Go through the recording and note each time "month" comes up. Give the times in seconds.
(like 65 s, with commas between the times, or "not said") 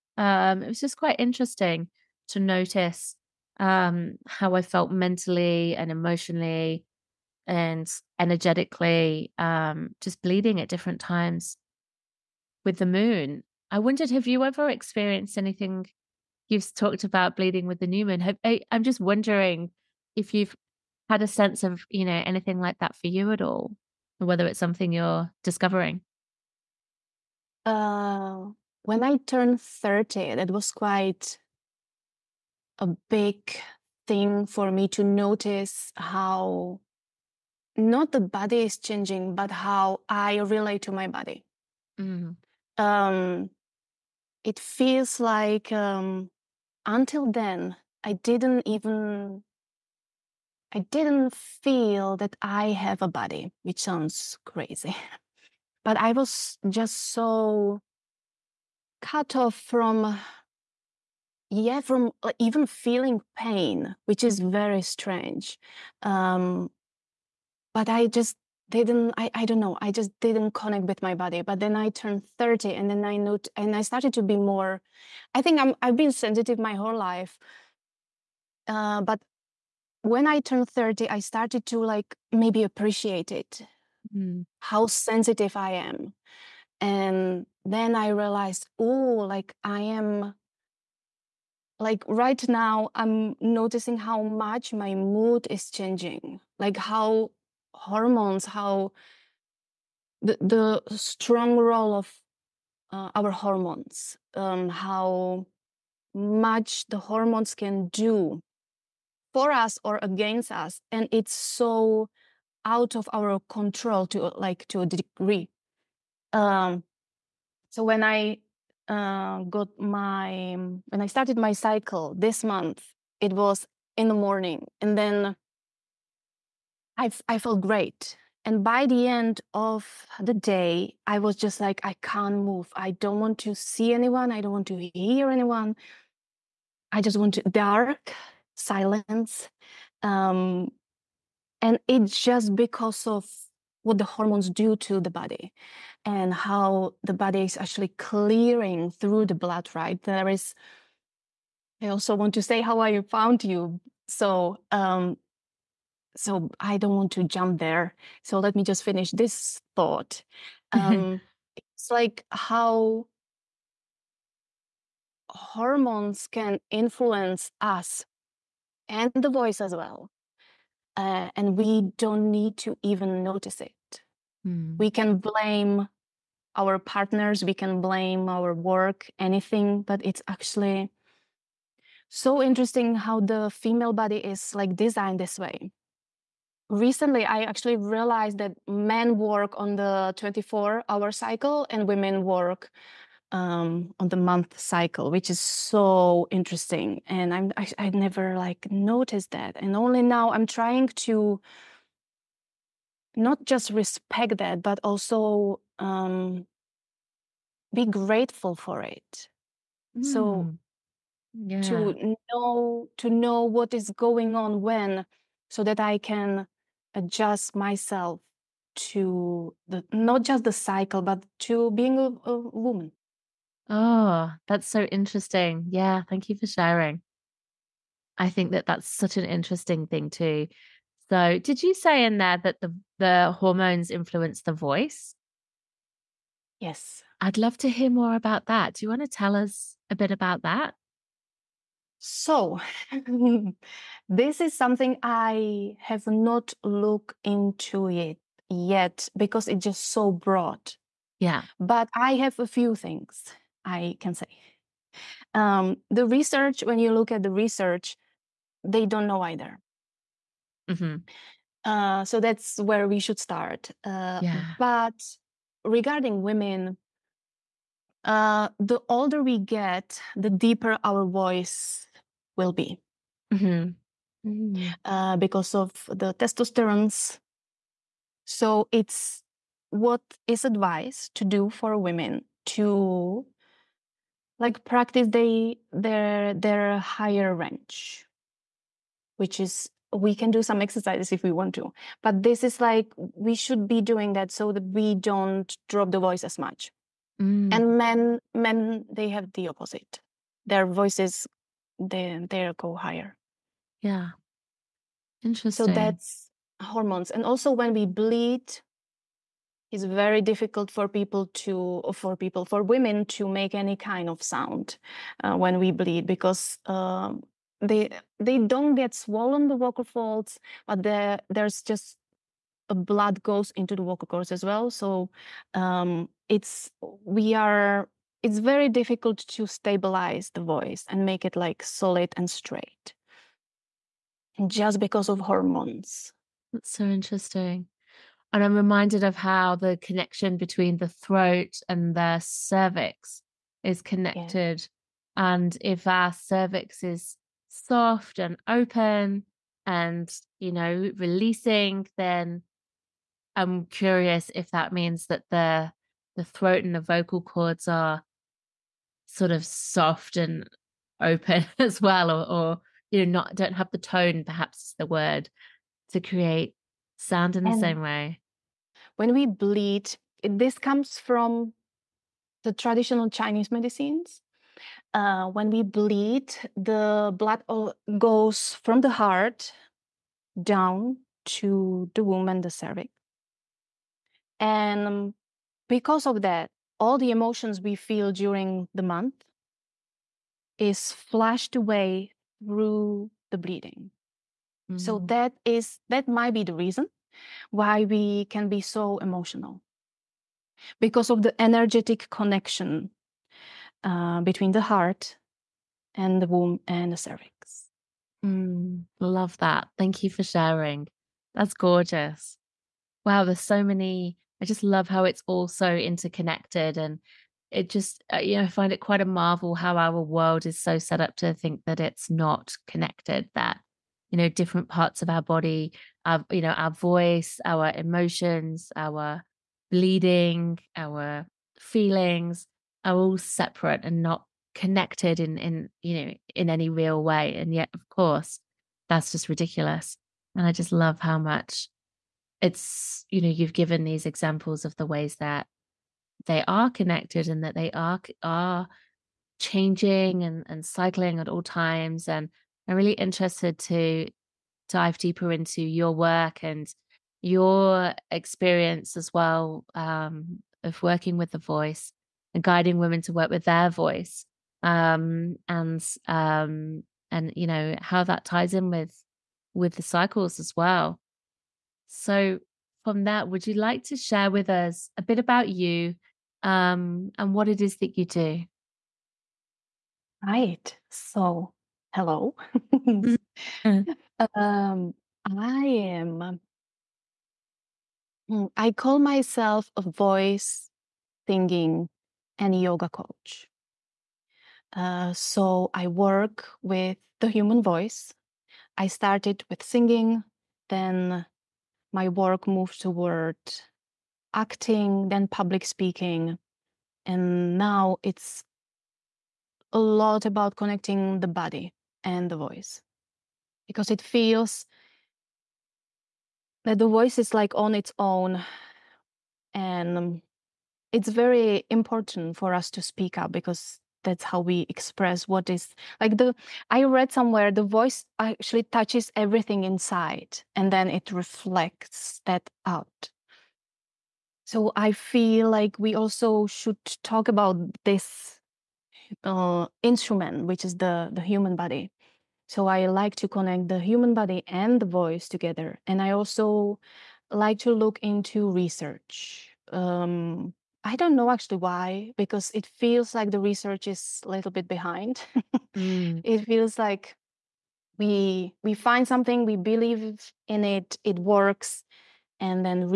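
122 s, 194 s, 388 s.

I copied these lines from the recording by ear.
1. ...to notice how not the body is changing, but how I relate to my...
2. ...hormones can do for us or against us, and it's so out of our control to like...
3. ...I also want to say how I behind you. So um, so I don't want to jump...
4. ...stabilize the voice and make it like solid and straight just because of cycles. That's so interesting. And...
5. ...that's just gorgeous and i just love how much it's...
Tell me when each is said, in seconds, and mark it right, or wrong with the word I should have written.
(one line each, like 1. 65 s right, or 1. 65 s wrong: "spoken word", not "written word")
1. 34 s right
2. 106 s right
3. 151 s wrong: "found", not "behind"
4. 329 s wrong: "hormones", not "cycles"
5. 438 s wrong: "ridiculous", not "gorgeous".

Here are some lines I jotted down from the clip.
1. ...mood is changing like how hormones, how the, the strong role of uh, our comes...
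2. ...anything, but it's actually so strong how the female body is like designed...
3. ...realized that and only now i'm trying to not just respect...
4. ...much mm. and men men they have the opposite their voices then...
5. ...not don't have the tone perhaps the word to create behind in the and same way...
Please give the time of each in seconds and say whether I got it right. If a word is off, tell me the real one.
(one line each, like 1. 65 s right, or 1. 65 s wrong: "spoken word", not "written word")
1. 94 s wrong: "hormones", not "comes"
2. 179 s wrong: "interesting", not "strong"
3. 198 s wrong: "noticed", not "realized"
4. 296 s right
5. 363 s wrong: "sound", not "behind".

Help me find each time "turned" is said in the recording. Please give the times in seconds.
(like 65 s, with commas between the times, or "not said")
29 s, 71 s, 80 s.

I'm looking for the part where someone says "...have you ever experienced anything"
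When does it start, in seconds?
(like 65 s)
14 s.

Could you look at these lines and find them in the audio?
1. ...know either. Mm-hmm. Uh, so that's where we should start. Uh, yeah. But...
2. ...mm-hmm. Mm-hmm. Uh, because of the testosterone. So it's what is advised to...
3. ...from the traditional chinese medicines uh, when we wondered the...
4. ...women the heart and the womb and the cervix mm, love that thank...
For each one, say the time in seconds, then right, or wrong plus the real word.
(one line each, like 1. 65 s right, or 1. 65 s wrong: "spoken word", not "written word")
1. 259 s right
2. 273 s right
3. 370 s wrong: "bleed", not "wondered"
4. 404 s wrong: "between", not "women".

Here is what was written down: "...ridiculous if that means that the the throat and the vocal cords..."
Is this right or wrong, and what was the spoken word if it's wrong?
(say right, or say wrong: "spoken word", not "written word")
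wrong: "curious", not "ridiculous".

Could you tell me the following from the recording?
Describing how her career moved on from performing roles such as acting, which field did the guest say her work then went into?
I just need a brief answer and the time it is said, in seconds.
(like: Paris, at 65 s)
public speaking, at 505 s.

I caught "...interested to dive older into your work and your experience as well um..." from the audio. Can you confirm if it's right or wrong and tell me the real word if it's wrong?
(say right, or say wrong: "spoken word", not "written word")
wrong: "deeper", not "older".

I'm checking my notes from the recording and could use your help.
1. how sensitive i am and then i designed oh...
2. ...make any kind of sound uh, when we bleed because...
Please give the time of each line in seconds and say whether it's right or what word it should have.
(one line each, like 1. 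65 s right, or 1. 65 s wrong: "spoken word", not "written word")
1. 84 s wrong: "realized", not "designed"
2. 313 s right.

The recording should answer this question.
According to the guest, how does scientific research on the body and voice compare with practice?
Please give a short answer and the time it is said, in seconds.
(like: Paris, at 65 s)
a little bit behind, at 554 s.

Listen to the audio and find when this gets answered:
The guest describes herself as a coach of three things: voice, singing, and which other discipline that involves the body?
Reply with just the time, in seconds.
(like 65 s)
492 s.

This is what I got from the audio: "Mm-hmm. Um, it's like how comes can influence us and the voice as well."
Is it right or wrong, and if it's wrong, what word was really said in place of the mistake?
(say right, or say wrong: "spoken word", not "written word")
wrong: "hormones", not "comes".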